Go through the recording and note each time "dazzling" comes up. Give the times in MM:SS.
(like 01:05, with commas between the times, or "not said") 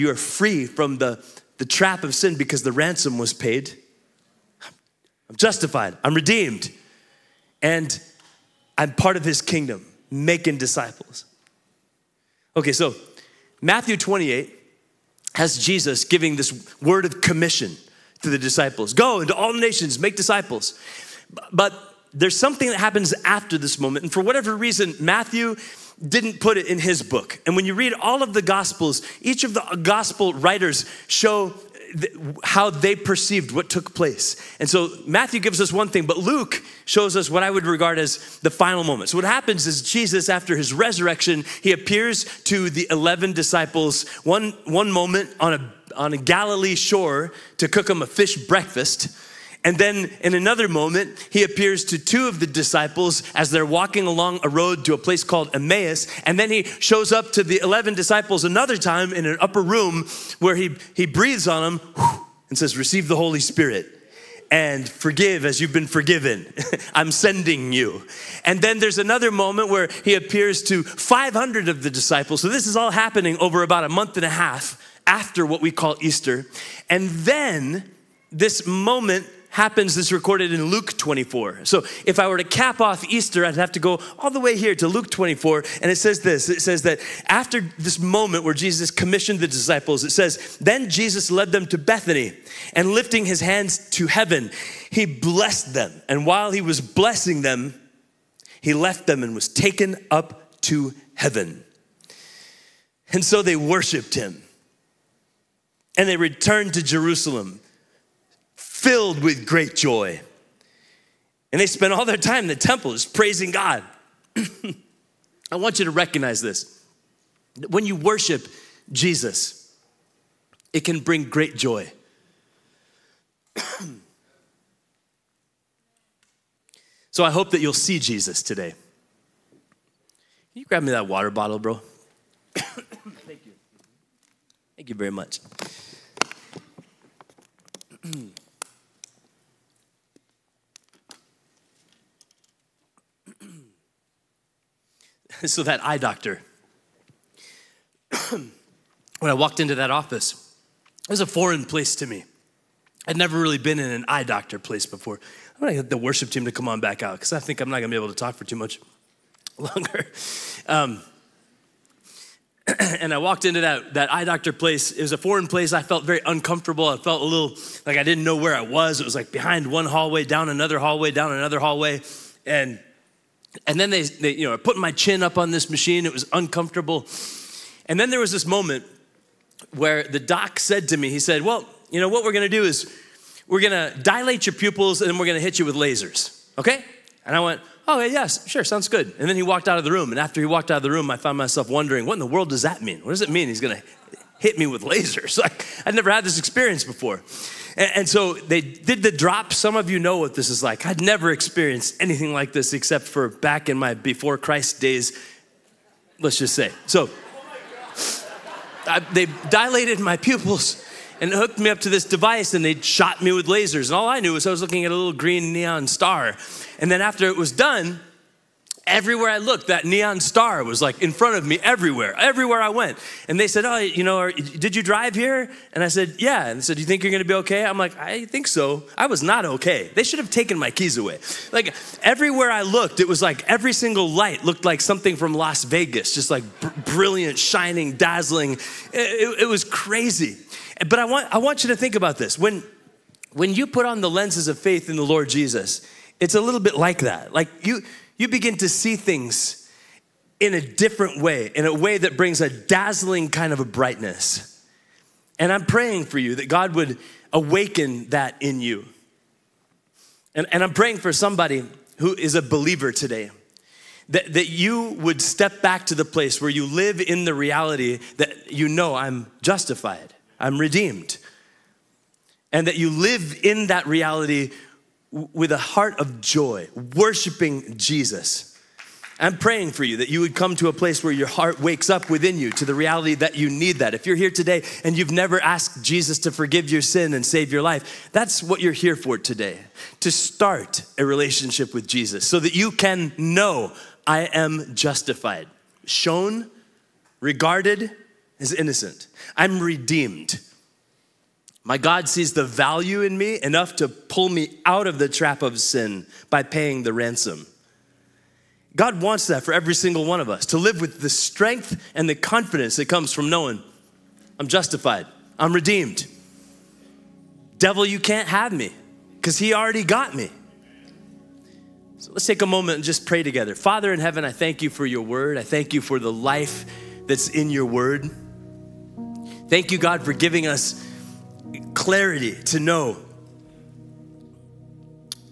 03:57, 04:12.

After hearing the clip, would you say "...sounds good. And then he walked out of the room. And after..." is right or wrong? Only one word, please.
right.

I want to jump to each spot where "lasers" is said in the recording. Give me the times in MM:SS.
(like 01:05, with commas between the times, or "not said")
03:05, 03:14, 03:33.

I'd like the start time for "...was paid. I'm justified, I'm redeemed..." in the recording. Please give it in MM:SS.
00:03.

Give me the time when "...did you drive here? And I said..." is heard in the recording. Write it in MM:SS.
03:44.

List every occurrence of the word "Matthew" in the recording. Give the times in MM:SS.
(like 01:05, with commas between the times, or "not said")
00:13, 00:24, 00:35.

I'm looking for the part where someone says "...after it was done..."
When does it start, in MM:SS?
03:37.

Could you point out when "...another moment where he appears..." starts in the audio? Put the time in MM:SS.
01:08.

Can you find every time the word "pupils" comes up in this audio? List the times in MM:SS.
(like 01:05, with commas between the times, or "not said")
03:04, 03:30.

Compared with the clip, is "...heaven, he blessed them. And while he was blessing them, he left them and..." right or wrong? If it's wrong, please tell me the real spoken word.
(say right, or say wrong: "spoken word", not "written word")
right.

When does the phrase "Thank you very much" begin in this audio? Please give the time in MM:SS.
02:14.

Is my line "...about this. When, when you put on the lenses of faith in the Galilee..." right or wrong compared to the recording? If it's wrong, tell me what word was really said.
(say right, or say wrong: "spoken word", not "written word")
wrong: "Lord", not "Galilee".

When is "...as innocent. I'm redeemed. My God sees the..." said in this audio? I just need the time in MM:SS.
04:58.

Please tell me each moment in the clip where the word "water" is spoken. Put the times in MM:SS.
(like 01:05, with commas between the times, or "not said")
02:11.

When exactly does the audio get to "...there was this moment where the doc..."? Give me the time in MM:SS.
02:58.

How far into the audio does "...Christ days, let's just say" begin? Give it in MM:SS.
03:24.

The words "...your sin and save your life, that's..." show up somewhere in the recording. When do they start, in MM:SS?
04:46.